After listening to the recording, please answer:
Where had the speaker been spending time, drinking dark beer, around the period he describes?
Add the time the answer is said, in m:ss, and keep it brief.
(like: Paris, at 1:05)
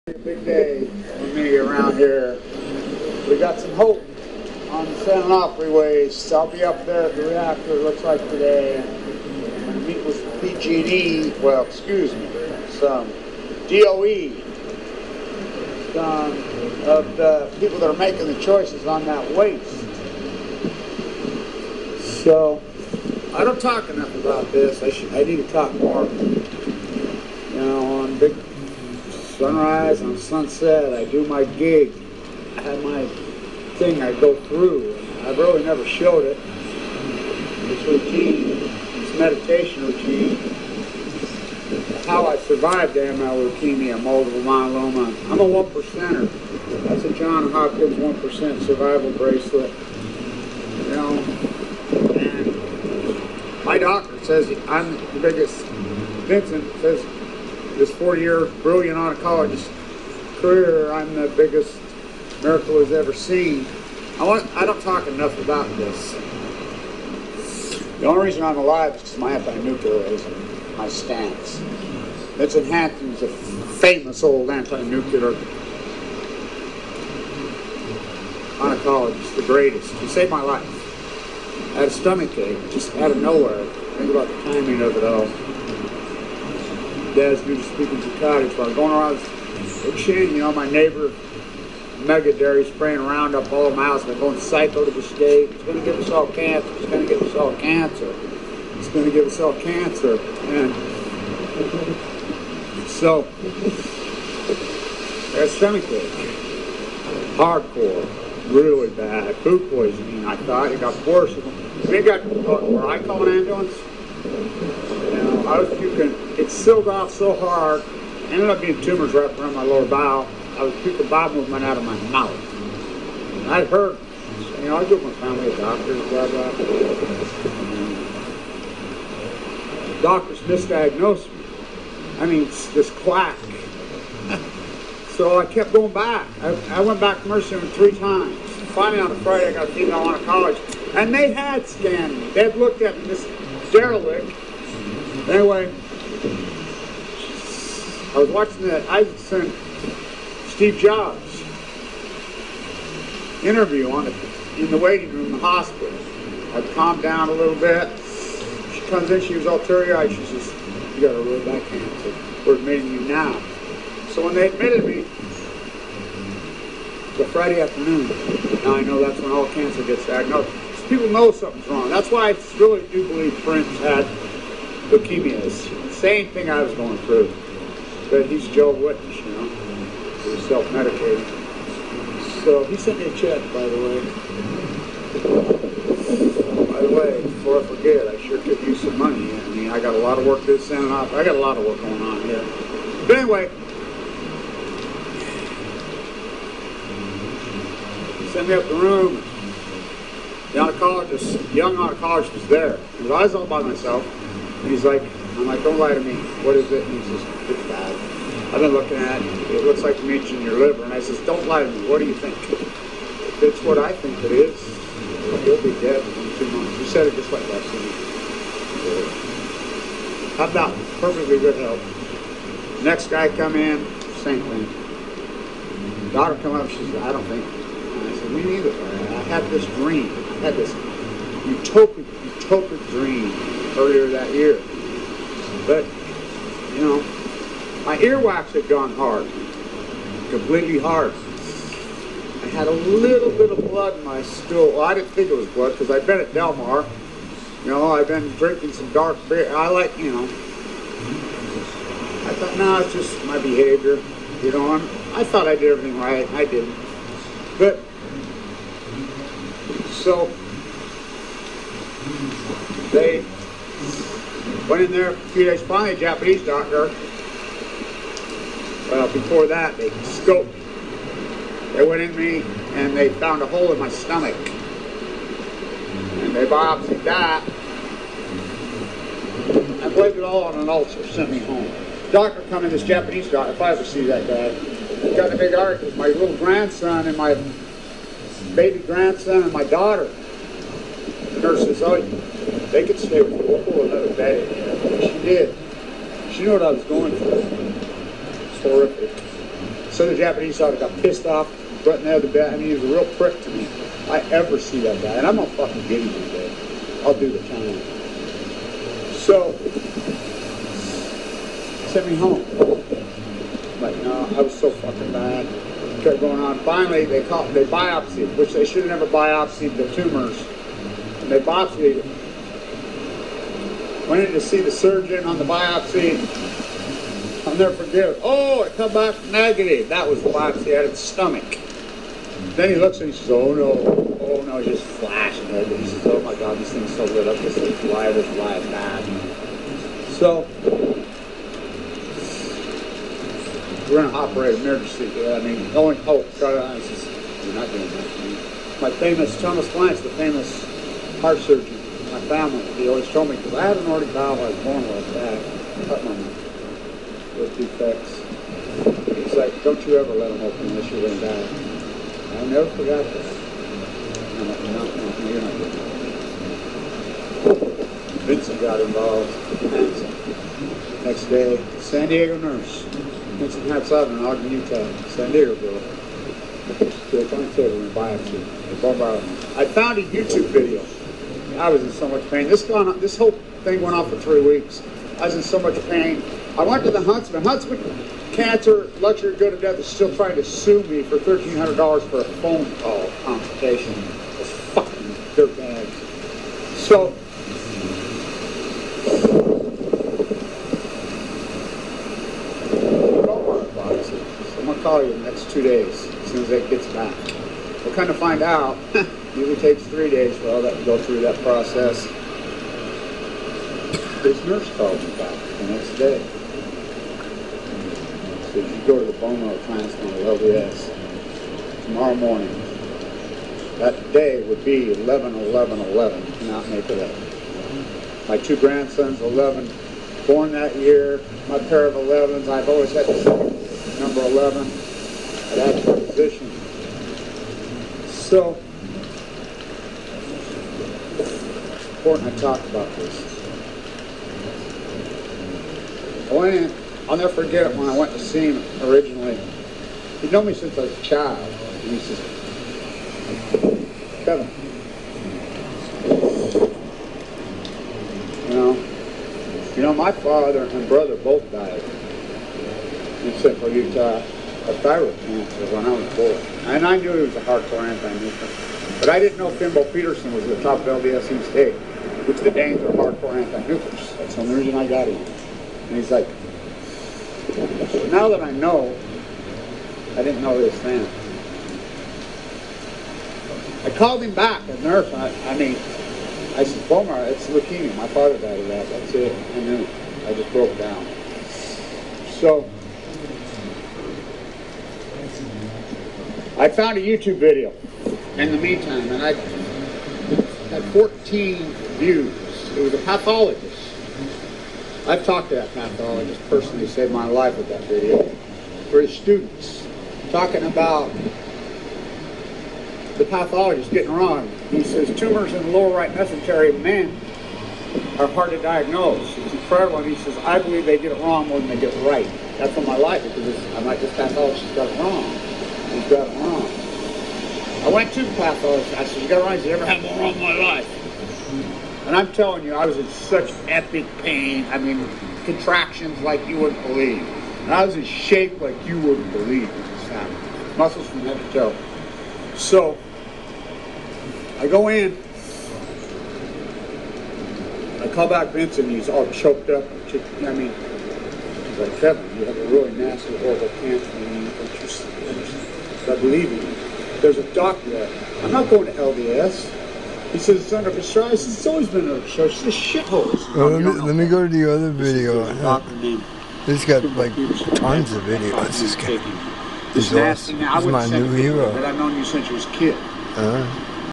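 Delmar, at 4:06.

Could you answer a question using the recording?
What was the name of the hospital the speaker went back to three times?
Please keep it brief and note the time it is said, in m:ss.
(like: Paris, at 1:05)
Mercy, at 2:17.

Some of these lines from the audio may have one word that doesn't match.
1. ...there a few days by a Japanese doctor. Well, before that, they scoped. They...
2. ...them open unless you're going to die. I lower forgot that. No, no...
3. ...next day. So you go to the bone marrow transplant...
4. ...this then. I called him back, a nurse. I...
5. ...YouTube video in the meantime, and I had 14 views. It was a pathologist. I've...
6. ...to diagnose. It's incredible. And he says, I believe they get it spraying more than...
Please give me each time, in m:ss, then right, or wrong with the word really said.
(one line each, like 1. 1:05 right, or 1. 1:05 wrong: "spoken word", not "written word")
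1. 4:24 right
2. 6:00 wrong: "never", not "lower"
3. 6:55 right
4. 8:00 right
5. 8:17 right
6. 8:38 wrong: "wrong", not "spraying".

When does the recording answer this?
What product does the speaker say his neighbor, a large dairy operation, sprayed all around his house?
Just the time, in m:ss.
1:33.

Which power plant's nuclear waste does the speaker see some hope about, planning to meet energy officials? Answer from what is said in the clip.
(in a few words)
San Onofre.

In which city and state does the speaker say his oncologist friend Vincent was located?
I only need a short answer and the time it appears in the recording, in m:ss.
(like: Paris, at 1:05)
Ogden, Utah, at 6:14.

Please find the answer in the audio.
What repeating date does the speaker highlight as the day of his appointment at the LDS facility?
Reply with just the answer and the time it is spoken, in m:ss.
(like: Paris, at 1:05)
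11/11/11, at 7:04.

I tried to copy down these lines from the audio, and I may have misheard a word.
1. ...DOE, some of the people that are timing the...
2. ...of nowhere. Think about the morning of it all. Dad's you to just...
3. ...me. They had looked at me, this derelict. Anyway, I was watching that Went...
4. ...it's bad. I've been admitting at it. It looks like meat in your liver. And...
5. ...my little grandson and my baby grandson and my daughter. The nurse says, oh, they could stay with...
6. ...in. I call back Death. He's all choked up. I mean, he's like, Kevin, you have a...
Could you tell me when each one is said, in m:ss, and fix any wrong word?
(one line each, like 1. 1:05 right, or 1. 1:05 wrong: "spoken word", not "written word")
1. 0:13 wrong: "making", not "timing"
2. 1:23 wrong: "timing", not "morning"
3. 2:22 wrong: "Isaacson", not "Went"
4. 3:27 wrong: "looking", not "admitting"
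5. 4:45 right
6. 9:04 wrong: "Vincent", not "Death".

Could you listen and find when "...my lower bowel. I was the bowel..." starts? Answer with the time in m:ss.
1:59.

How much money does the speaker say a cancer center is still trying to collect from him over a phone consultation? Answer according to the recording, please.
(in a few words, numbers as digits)
$1300.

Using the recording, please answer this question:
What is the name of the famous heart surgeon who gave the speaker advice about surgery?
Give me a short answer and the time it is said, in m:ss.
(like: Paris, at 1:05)
Thomas Blanch, at 5:49.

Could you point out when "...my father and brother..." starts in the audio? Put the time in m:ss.
7:39.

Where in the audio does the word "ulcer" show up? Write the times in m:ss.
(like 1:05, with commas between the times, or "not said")
4:40.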